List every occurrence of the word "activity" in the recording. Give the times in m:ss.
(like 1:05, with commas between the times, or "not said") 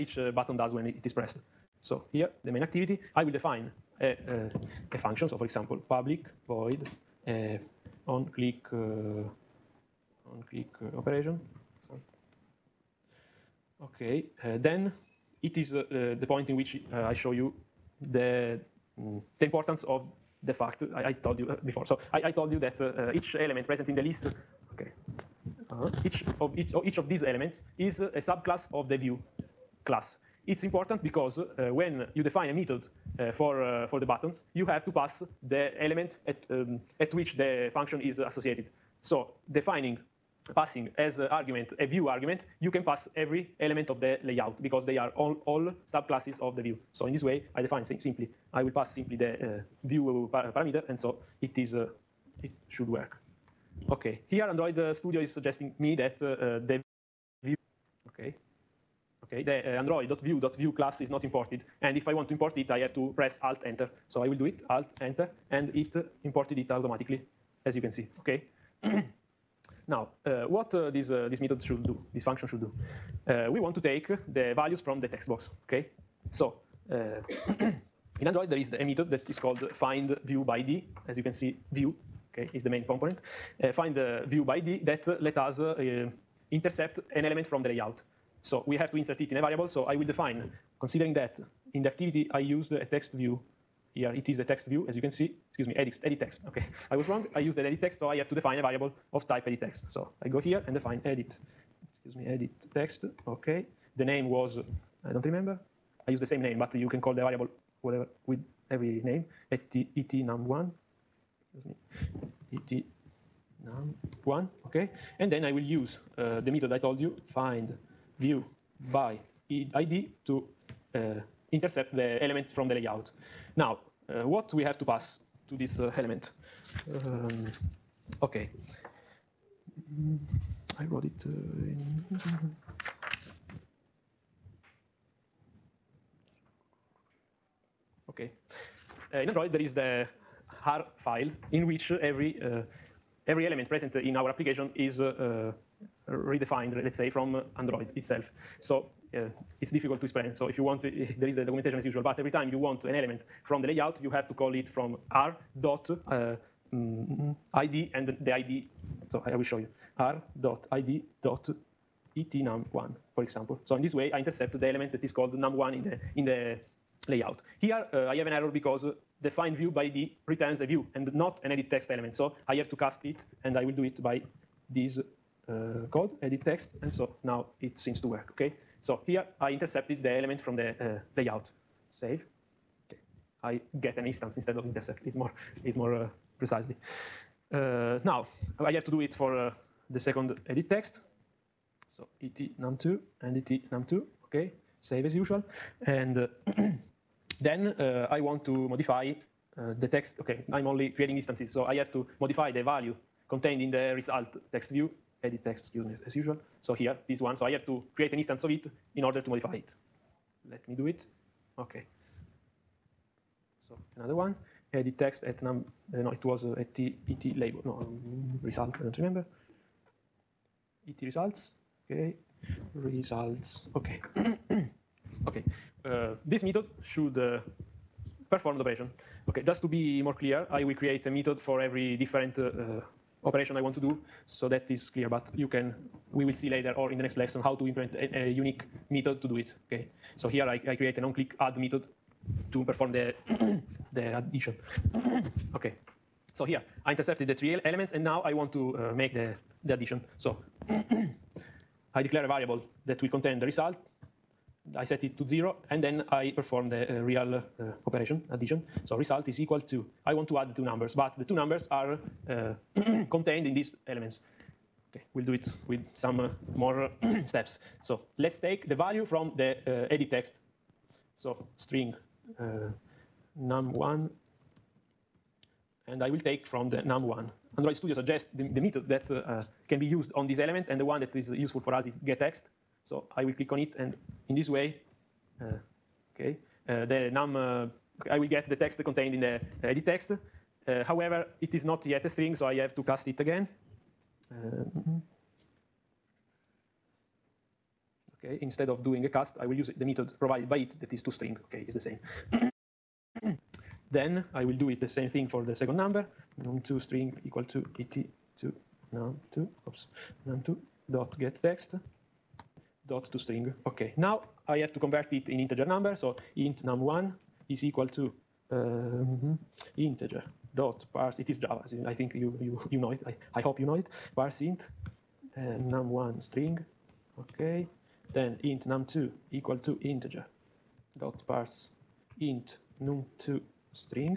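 0:02, 1:31.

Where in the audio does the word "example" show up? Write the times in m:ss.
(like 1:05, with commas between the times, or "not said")
0:05, 2:43.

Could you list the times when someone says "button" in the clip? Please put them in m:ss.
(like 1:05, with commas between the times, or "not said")
0:00, 0:34.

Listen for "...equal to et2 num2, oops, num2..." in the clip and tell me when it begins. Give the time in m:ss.
5:07.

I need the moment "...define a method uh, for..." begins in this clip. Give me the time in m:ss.
0:32.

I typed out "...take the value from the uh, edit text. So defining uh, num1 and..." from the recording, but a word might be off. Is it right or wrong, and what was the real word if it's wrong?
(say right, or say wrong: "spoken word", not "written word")
wrong: "string", not "defining".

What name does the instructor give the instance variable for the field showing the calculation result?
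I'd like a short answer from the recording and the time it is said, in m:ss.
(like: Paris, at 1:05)
ET results, at 3:40.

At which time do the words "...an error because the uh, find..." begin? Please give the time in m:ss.
2:48.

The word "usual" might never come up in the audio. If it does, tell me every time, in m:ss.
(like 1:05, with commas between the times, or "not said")
2:31, 3:15, 3:26.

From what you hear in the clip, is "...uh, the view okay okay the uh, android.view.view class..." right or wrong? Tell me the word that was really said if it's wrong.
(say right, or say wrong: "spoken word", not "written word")
right.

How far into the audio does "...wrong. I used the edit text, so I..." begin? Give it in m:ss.
1:37.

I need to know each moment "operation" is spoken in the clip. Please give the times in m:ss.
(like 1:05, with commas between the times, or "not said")
0:10, 3:48, 3:53, 4:17.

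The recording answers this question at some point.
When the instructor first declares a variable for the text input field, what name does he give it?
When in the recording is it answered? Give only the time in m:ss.
1:52.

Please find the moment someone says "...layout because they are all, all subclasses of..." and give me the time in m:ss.
0:44.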